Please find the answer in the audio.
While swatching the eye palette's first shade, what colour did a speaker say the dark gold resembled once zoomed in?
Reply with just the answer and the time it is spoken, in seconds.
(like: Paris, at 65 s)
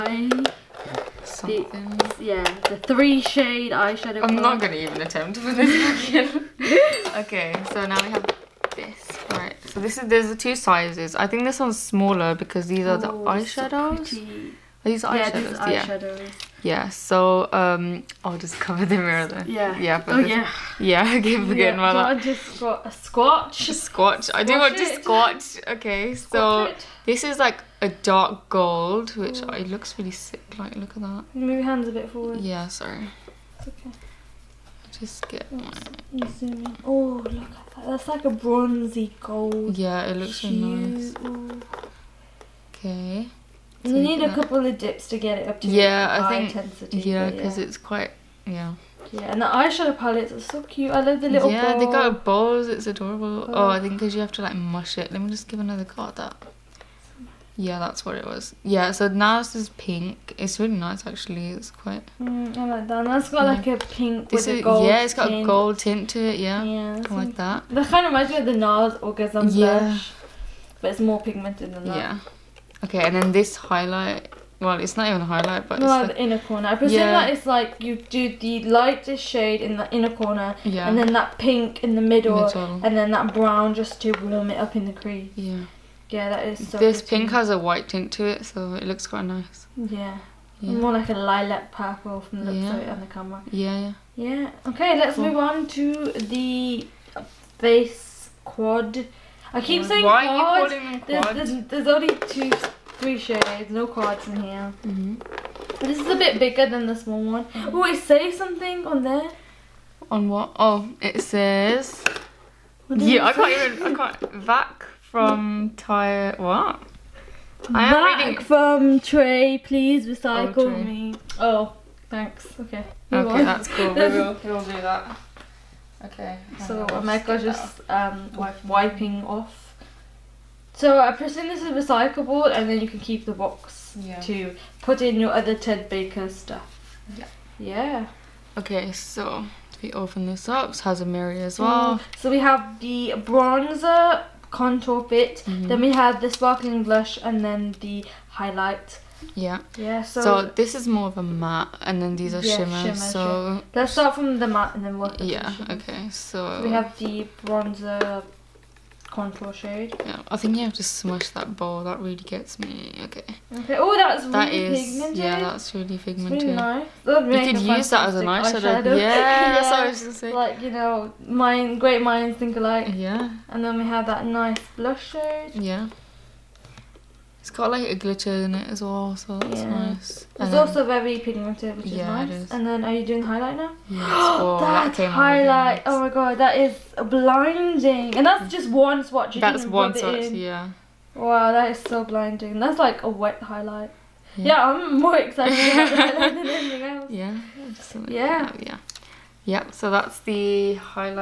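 bronzy gold, at 38 s.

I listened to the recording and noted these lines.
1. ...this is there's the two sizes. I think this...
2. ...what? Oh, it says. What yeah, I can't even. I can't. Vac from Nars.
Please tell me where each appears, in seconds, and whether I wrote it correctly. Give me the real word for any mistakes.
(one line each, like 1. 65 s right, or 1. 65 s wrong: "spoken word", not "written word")
1. 9 s right
2. 110 s wrong: "Tyre", not "Nars".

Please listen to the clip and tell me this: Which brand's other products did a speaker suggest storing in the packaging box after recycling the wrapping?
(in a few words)
Ted Baker.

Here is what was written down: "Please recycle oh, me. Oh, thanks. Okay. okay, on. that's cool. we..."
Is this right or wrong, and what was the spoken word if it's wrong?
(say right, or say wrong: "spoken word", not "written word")
right.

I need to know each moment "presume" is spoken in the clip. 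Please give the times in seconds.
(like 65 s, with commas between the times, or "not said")
76 s, 131 s.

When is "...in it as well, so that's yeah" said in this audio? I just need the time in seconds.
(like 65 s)
178 s.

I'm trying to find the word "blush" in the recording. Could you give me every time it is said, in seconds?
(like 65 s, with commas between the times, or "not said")
69 s, 146 s, 174 s.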